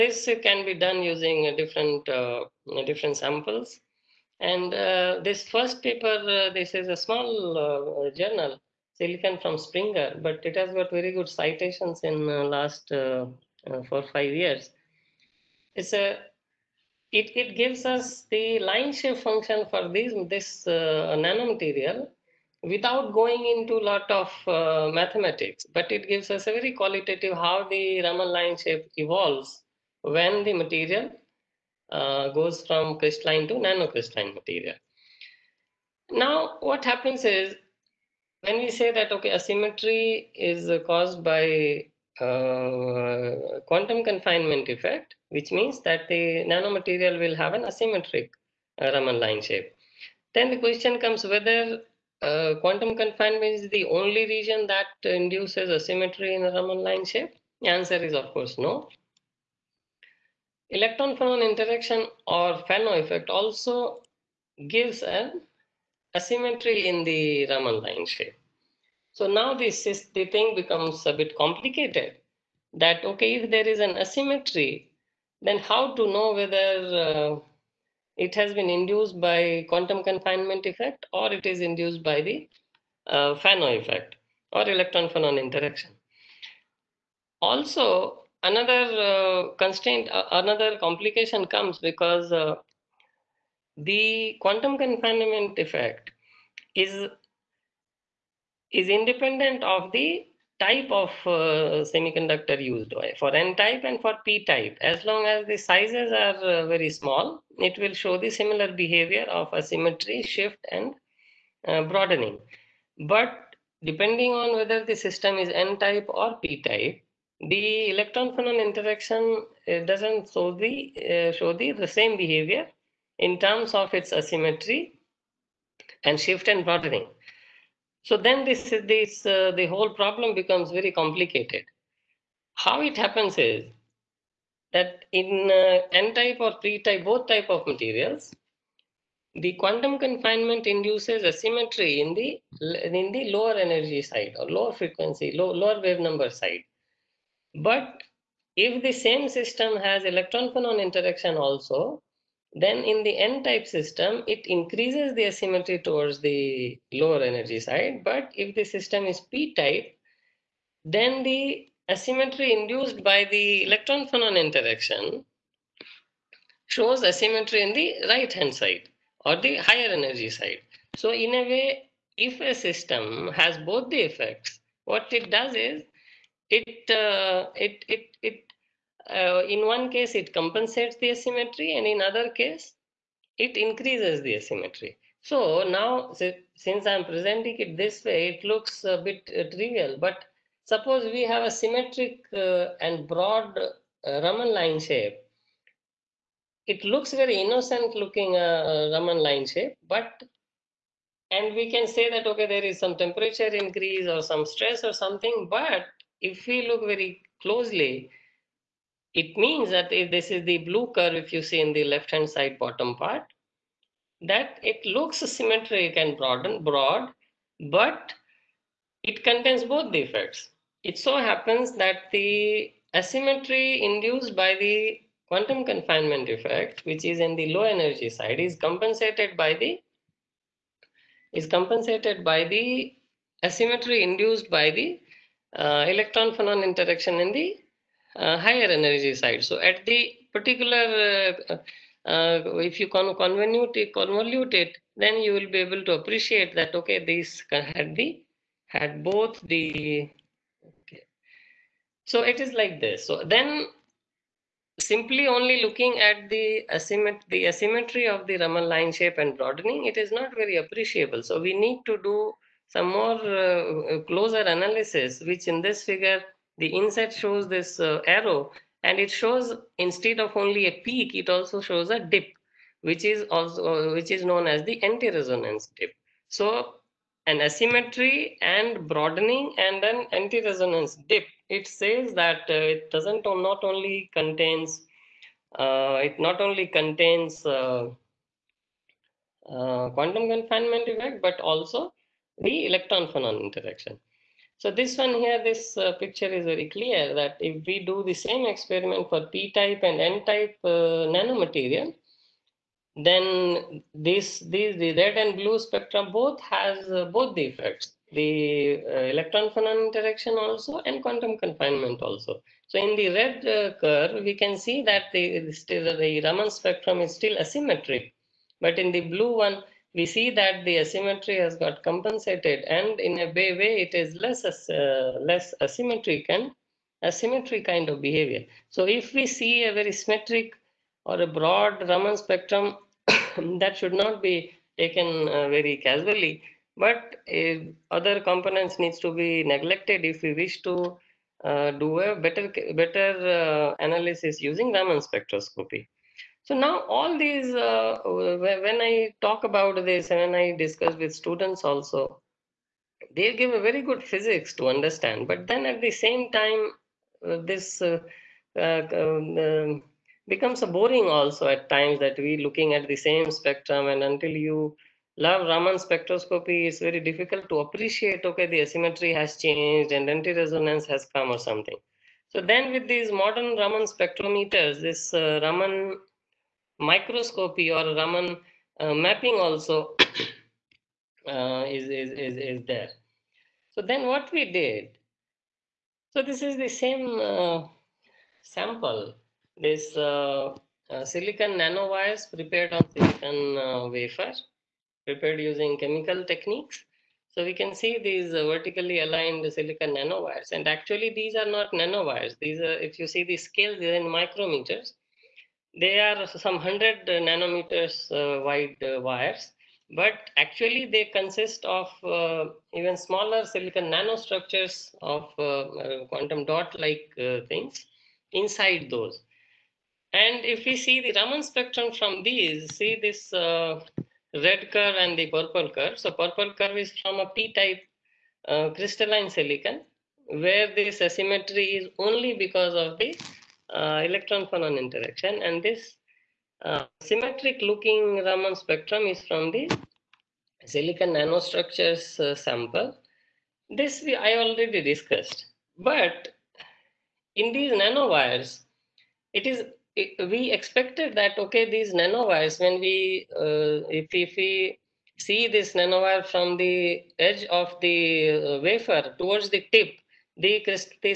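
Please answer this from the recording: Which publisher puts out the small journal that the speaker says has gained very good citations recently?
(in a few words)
Springer.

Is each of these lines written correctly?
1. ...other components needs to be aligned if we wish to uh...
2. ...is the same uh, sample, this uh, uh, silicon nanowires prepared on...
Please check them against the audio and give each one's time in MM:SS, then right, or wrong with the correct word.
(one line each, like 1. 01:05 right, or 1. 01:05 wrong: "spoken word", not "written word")
1. 05:37 wrong: "neglected", not "aligned"
2. 06:26 right.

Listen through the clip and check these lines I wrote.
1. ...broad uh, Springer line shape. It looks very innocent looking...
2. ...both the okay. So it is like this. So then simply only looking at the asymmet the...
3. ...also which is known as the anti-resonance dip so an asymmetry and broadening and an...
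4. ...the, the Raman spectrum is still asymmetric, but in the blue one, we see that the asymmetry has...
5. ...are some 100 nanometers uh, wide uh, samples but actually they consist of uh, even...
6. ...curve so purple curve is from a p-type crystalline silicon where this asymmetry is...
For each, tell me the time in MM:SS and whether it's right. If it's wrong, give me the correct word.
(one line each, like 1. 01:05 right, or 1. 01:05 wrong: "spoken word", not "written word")
1. 03:13 wrong: "Raman", not "Springer"
2. 04:09 right
3. 04:33 right
4. 05:15 right
5. 06:45 wrong: "wires", not "samples"
6. 07:05 right.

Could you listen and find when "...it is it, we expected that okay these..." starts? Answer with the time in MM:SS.
07:29.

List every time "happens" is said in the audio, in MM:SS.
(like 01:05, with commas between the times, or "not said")
00:36, 02:12, 03:41.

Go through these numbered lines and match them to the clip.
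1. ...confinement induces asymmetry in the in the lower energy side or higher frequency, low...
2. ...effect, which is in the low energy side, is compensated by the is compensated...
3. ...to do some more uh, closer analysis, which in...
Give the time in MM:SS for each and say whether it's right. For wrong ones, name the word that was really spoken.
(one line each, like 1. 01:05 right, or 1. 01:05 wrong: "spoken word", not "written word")
1. 02:19 wrong: "lower", not "higher"
2. 03:46 right
3. 04:21 right.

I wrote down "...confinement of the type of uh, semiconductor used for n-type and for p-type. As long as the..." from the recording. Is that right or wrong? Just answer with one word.
wrong.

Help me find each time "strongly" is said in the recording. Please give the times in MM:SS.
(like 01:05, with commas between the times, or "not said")
not said.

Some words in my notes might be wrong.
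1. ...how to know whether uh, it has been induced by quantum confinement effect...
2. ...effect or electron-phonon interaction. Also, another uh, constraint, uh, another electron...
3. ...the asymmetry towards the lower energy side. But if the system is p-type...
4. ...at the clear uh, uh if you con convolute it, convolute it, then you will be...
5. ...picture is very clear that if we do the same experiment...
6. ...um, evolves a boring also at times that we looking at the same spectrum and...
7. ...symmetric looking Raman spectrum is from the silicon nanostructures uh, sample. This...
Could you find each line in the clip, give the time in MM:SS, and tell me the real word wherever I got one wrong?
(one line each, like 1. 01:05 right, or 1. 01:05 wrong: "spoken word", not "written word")
1. 01:15 right
2. 01:23 wrong: "complication", not "electron"
3. 02:35 right
4. 03:59 wrong: "particular", not "clear"
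5. 04:55 right
6. 05:59 wrong: "becomes", not "evolves"
7. 07:16 right.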